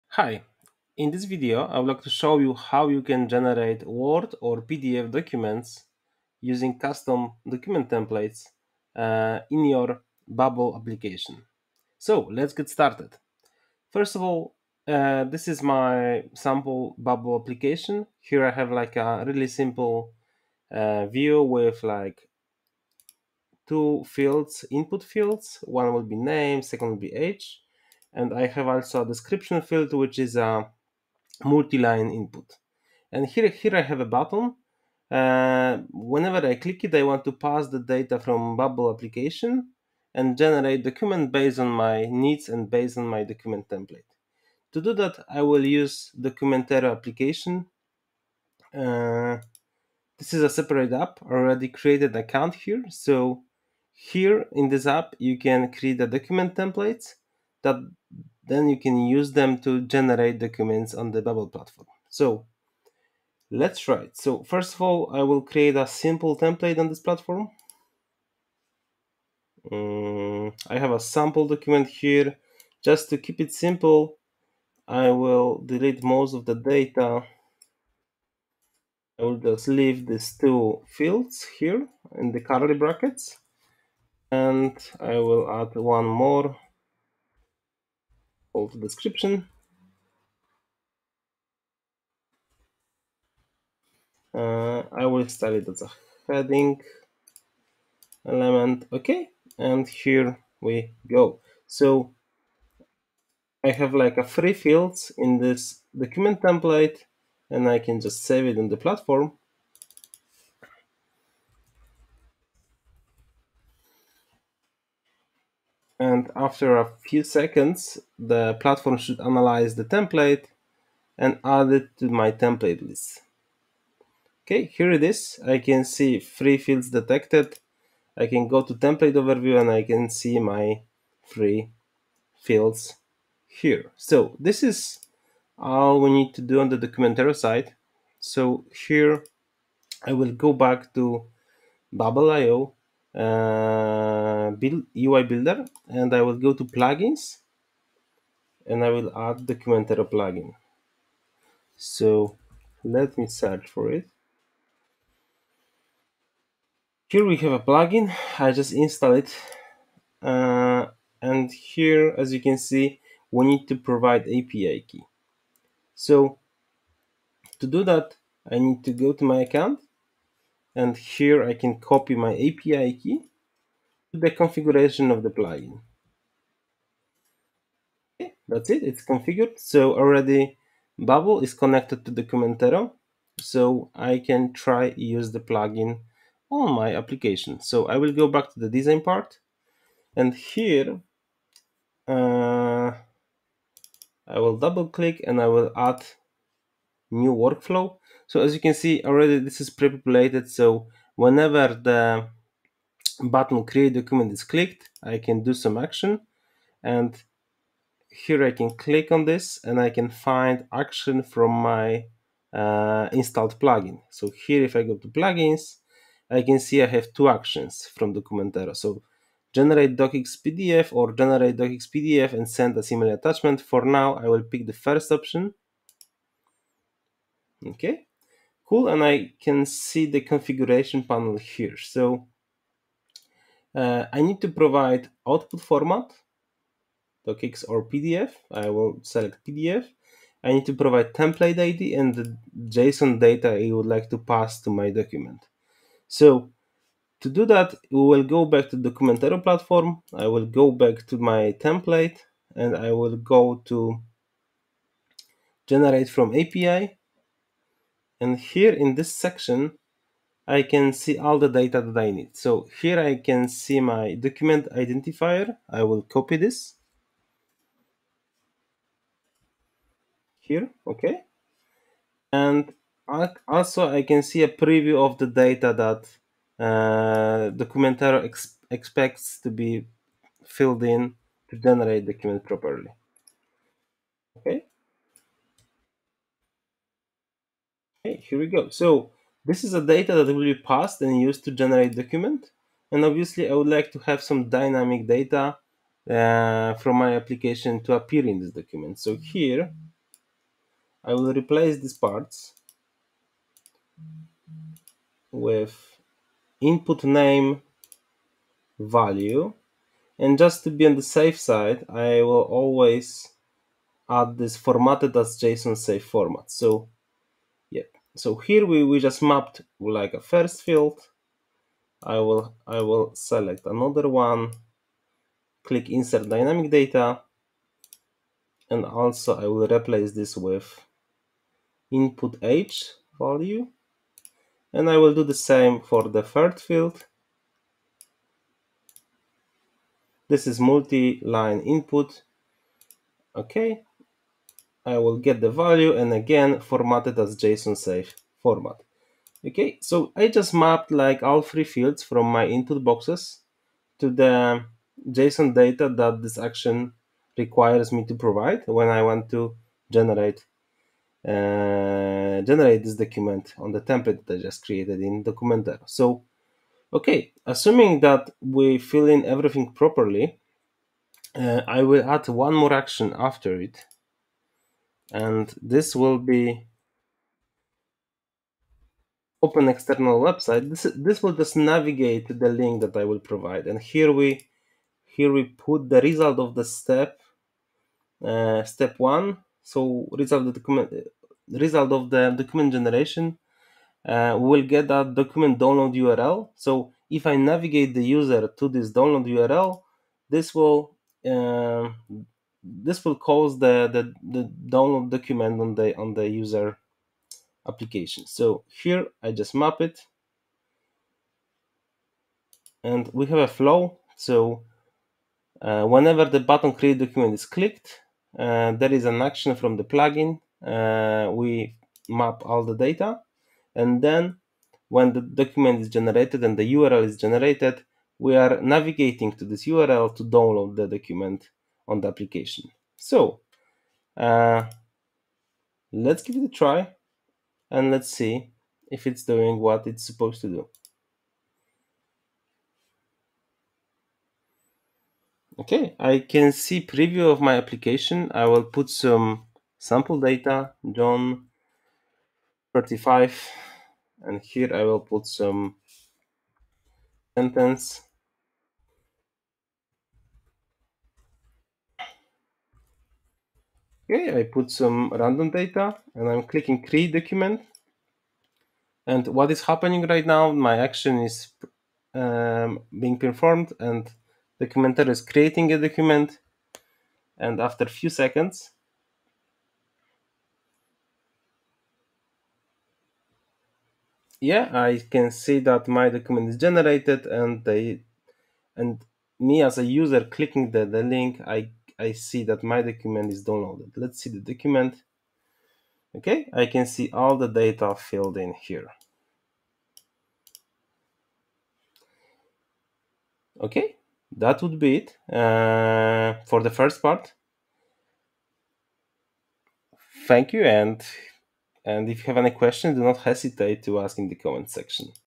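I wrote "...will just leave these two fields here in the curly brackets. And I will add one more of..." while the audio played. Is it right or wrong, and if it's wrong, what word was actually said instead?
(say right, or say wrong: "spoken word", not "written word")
right.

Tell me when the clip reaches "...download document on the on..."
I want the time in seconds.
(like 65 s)
404 s.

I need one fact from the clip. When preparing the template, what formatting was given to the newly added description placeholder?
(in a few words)
As a heading.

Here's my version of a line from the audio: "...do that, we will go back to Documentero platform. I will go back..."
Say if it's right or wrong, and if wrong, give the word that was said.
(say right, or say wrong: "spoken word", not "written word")
right.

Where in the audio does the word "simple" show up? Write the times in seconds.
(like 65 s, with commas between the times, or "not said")
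19 s, 65 s, 73 s.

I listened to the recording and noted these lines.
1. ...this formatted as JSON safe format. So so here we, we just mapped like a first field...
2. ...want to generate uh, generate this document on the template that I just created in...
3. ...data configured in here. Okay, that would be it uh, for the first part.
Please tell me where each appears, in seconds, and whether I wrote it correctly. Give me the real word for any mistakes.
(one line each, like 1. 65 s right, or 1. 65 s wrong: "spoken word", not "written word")
1. 314 s right
2. 359 s right
3. 497 s wrong: "filled", not "configured".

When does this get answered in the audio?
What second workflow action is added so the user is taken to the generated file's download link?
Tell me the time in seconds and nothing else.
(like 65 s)
379 s.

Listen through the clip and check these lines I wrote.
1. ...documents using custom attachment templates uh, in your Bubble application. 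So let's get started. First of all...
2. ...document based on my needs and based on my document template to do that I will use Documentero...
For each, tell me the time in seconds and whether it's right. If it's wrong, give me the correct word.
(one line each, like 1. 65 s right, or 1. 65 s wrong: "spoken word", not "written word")
1. 5 s wrong: "document", not "attachment"
2. 40 s right.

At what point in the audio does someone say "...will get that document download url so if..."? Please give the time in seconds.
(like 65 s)
394 s.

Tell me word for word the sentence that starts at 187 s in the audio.
So I will go back to the design part and here uh, I will double click and I will add new workflow.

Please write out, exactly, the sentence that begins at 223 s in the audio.
For now, I will pick the first option Okay, cool.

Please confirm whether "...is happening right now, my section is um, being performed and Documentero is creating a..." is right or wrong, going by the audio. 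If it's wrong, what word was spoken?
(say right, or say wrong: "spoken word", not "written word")
wrong: "action", not "section".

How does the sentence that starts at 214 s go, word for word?
So here if I go to plugins, I can see I have two actions from Documentero.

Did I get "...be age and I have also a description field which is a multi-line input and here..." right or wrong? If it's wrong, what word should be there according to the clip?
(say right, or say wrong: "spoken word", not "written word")
right.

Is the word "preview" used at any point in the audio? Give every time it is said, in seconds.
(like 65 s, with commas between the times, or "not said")
274 s, 446 s.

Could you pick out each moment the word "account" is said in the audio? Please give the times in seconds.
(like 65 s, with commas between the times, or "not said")
52 s, 169 s.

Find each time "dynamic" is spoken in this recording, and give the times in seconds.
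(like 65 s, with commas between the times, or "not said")
294 s, 326 s.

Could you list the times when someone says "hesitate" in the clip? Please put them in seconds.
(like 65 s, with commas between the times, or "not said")
513 s.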